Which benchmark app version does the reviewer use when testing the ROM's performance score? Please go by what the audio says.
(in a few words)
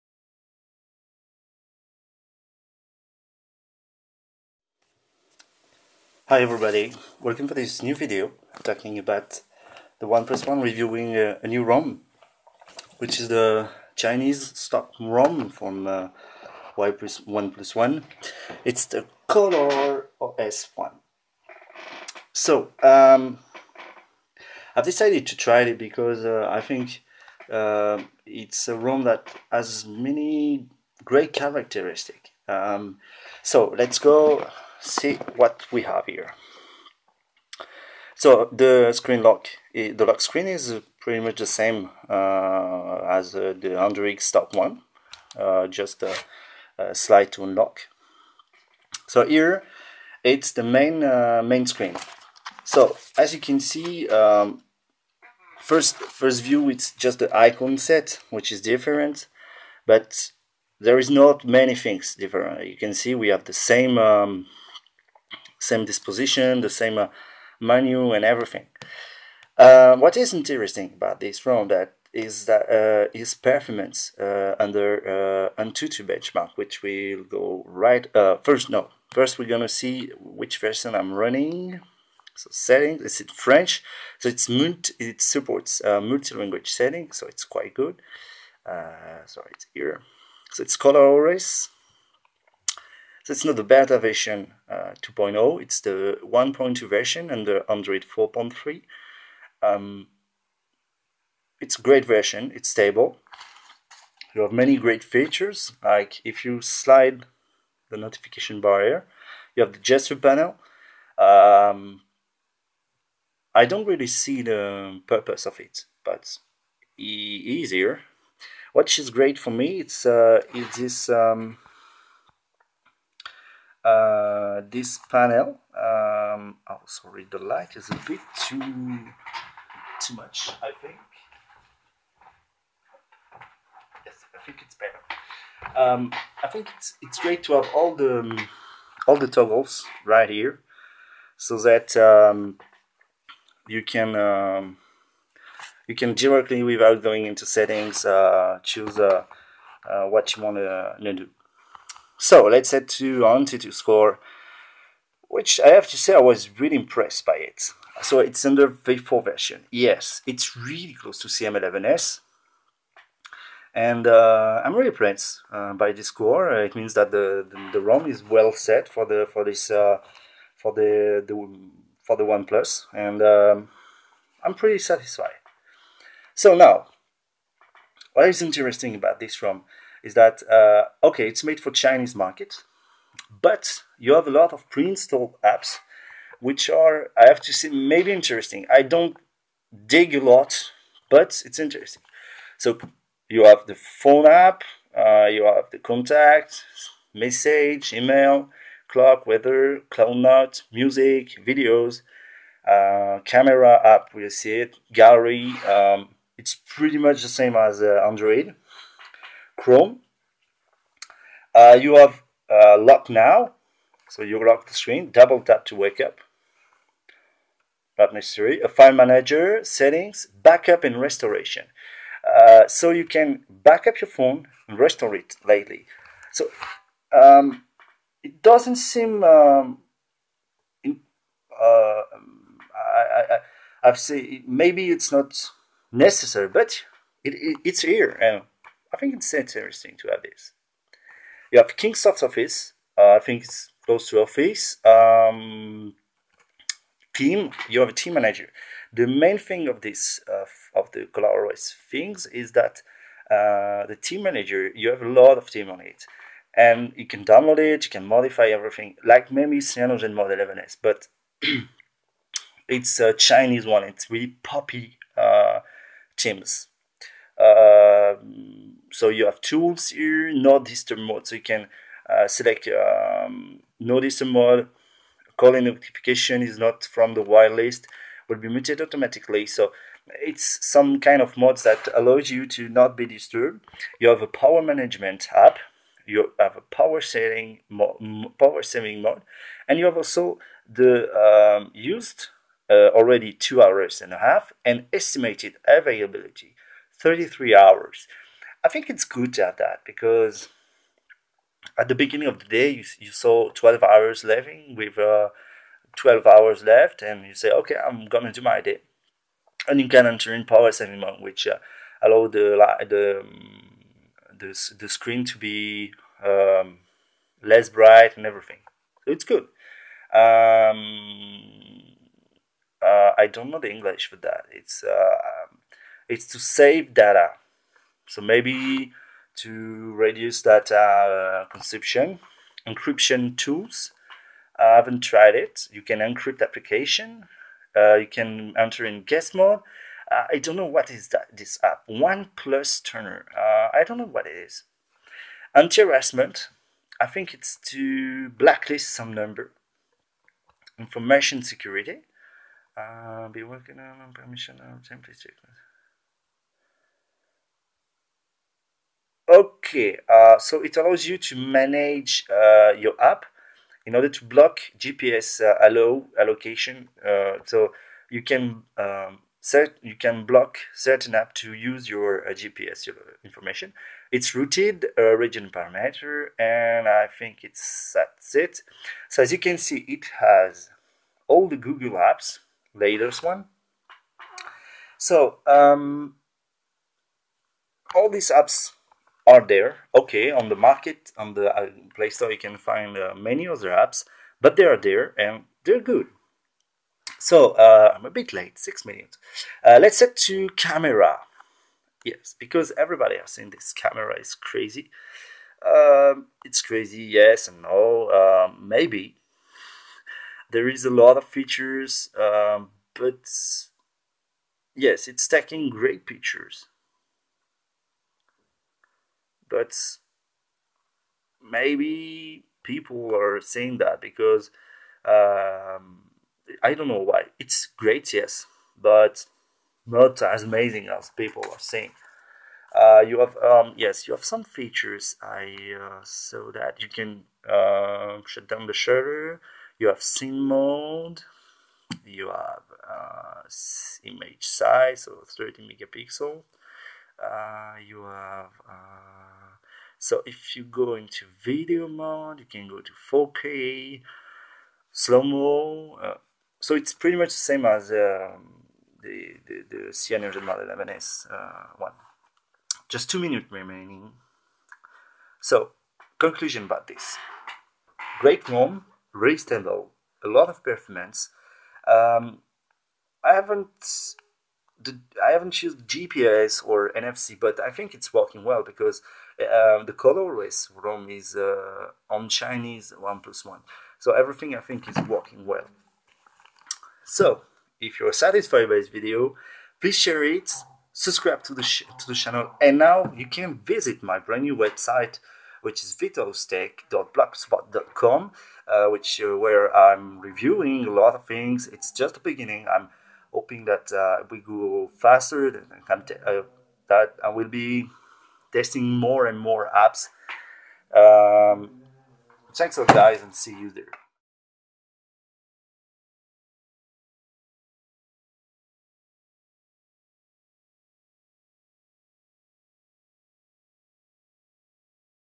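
V4.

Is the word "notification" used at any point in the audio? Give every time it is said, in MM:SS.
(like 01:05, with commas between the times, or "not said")
01:47, 04:35.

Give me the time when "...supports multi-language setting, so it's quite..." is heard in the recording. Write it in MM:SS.
01:25.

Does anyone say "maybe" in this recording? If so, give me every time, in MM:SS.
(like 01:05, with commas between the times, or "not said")
03:07, 03:54, 04:19, 05:28, 06:48, 07:01.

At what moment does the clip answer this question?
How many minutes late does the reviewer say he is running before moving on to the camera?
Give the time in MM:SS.
06:38.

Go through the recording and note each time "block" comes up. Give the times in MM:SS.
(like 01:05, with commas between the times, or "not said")
06:04, 06:10.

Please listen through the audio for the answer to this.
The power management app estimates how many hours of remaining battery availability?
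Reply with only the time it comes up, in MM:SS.
04:56.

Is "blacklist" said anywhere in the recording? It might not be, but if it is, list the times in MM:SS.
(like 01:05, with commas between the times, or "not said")
05:48.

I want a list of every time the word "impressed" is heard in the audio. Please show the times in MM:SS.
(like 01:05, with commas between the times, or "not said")
02:36, 02:44.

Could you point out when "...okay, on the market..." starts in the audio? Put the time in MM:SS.
06:29.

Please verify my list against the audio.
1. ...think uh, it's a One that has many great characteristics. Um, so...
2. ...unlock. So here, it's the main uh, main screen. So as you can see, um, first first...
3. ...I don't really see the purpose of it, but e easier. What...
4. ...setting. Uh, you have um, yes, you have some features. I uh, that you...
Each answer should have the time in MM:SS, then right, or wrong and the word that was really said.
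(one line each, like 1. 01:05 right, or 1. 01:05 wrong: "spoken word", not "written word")
1. 00:26 wrong: "ROM", not "One"
2. 00:47 right
3. 01:53 right
4. 07:11 wrong: "saying", not "setting".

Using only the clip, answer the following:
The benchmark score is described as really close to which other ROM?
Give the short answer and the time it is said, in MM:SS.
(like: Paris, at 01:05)
CM11S, at 02:41.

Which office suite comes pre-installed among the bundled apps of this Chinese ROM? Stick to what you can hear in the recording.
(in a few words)
Kingsoft Office.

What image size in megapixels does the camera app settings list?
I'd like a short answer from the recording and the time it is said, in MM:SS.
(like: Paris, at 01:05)
30 megapixel, at 07:25.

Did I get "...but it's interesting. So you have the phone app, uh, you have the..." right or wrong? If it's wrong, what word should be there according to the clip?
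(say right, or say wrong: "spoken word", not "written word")
right.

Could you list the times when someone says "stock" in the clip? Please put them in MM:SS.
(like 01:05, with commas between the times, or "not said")
00:14, 00:44.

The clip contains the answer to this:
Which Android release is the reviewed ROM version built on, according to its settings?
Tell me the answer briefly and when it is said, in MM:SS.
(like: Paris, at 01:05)
Android 4.3, at 01:37.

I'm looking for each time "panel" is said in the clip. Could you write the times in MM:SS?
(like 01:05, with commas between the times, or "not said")
01:50, 02:05.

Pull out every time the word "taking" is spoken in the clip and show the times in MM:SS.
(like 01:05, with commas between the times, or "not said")
06:55.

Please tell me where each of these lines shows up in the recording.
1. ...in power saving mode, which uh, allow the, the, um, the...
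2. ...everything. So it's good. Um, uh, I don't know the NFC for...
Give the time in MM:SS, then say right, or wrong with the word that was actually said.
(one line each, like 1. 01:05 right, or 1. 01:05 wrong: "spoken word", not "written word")
1. 05:10 right
2. 05:18 wrong: "English", not "NFC".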